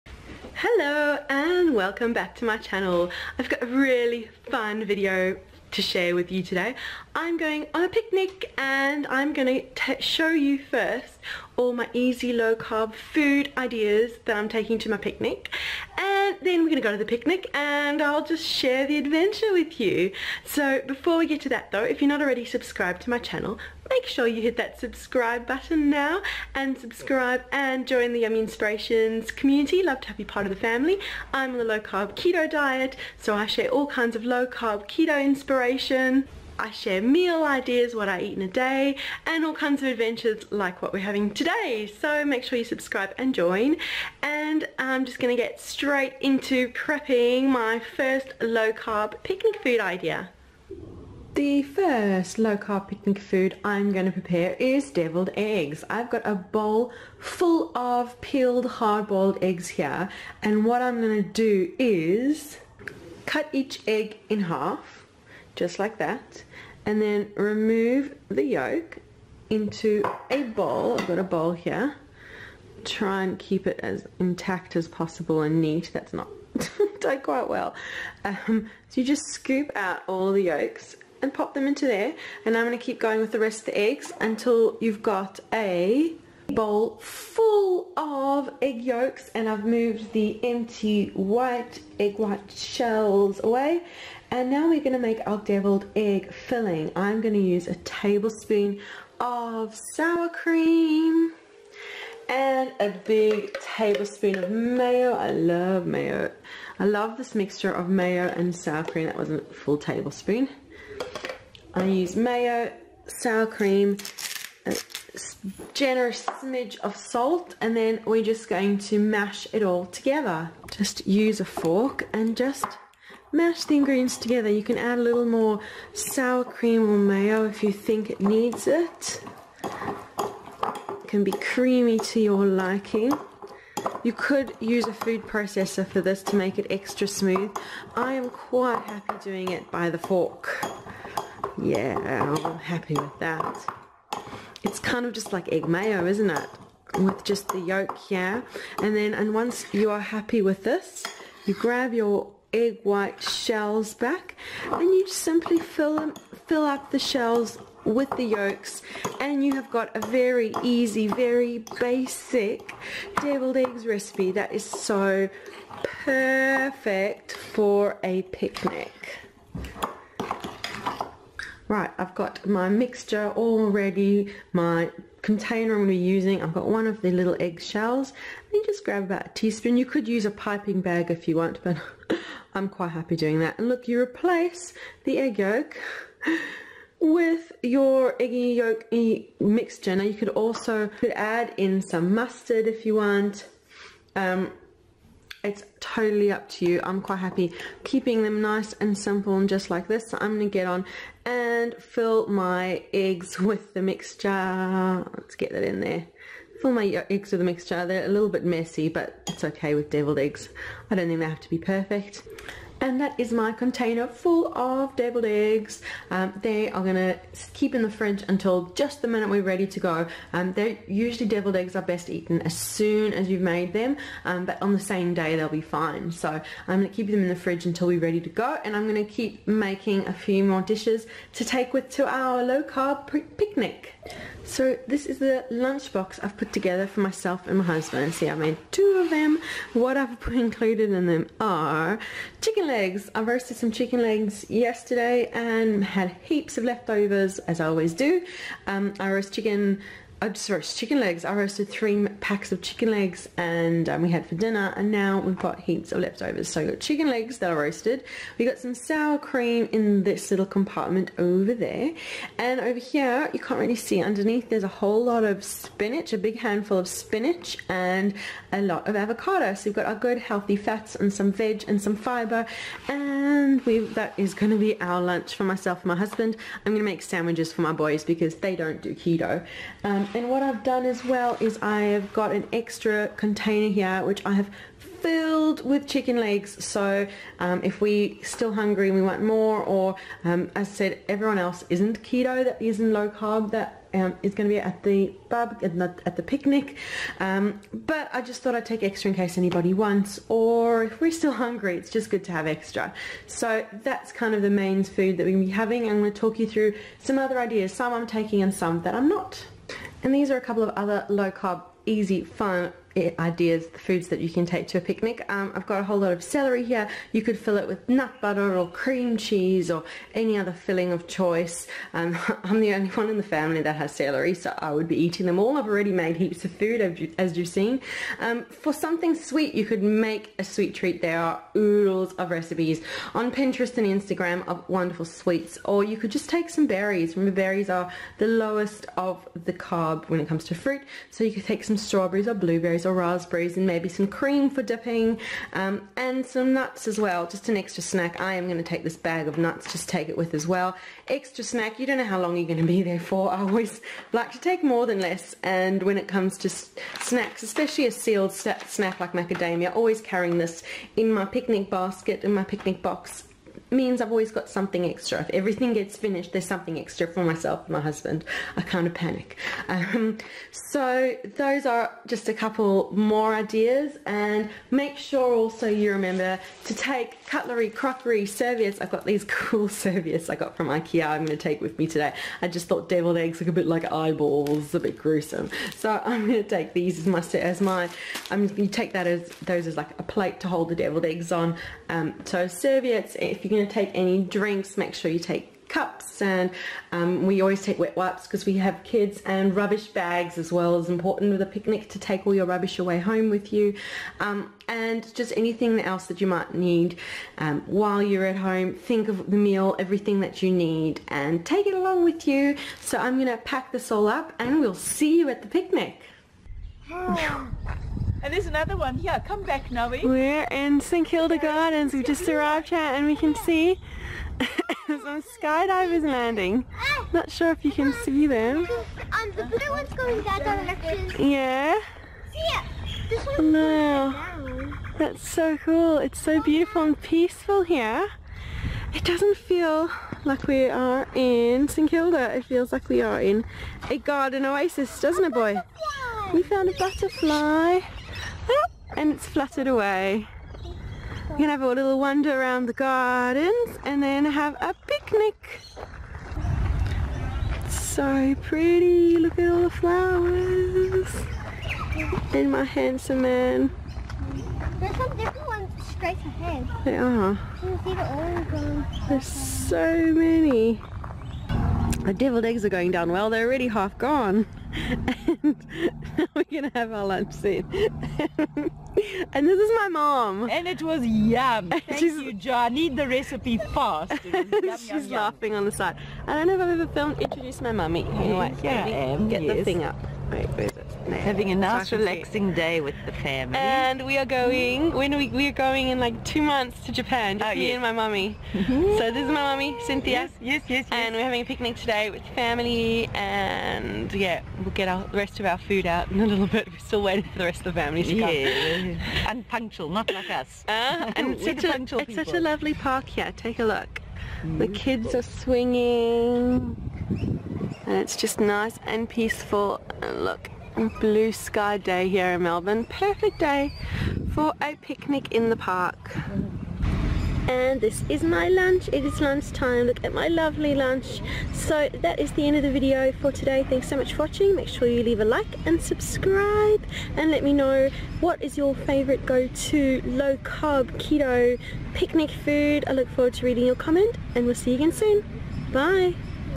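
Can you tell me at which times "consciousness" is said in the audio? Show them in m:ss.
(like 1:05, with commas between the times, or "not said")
not said.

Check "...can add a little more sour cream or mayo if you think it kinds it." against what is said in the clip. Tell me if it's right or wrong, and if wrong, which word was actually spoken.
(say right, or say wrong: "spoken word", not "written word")
wrong: "needs", not "kinds".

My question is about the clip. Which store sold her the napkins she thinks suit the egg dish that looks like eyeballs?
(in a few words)
Ikea.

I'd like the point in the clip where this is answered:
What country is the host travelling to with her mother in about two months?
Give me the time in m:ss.
8:16.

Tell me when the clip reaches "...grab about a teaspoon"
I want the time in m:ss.
2:58.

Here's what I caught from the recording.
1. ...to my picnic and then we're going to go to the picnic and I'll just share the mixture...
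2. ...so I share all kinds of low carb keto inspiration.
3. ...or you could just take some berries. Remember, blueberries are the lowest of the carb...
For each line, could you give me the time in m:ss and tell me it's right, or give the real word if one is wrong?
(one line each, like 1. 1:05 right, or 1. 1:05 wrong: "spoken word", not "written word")
1. 0:14 wrong: "adventure", not "mixture"
2. 0:33 right
3. 5:35 wrong: "berries", not "blueberries".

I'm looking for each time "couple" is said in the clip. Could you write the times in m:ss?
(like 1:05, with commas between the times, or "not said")
5:10, 6:12.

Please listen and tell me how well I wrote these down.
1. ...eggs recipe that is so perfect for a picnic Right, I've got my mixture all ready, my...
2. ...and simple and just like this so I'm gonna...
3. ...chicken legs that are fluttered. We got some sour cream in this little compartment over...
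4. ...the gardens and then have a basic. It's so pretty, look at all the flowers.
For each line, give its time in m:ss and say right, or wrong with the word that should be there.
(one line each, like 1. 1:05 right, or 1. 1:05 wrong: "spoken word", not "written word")
1. 2:43 right
2. 3:18 right
3. 4:16 wrong: "roasted", not "fluttered"
4. 7:32 wrong: "picnic", not "basic".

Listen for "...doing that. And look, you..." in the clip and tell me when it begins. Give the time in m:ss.
3:03.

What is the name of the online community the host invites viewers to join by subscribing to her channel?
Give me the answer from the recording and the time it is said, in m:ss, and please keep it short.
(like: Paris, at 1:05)
Yummy Inspirations, at 0:28.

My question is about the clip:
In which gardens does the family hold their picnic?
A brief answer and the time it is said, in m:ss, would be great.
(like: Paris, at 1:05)
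St. Kilda Gardens, at 7:00.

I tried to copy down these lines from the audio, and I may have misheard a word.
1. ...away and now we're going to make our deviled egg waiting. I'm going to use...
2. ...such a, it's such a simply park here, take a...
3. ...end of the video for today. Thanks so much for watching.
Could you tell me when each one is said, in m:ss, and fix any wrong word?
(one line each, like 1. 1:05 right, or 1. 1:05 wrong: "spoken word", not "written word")
1. 1:33 wrong: "filling", not "waiting"
2. 8:31 wrong: "lovely", not "simply"
3. 8:52 right.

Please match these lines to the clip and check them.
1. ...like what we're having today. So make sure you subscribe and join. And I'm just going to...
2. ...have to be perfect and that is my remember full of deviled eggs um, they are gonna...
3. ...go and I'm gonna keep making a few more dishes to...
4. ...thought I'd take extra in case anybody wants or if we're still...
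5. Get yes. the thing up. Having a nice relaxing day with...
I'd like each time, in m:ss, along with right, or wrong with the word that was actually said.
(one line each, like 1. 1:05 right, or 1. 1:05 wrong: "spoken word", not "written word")
1. 0:40 right
2. 3:31 wrong: "container", not "remember"
3. 3:48 right
4. 4:58 right
5. 8:09 right.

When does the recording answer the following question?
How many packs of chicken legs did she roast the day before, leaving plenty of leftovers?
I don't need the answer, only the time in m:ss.
4:11.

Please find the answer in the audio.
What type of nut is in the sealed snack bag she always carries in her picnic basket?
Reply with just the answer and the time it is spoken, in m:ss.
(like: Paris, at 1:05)
Macadamia, at 5:59.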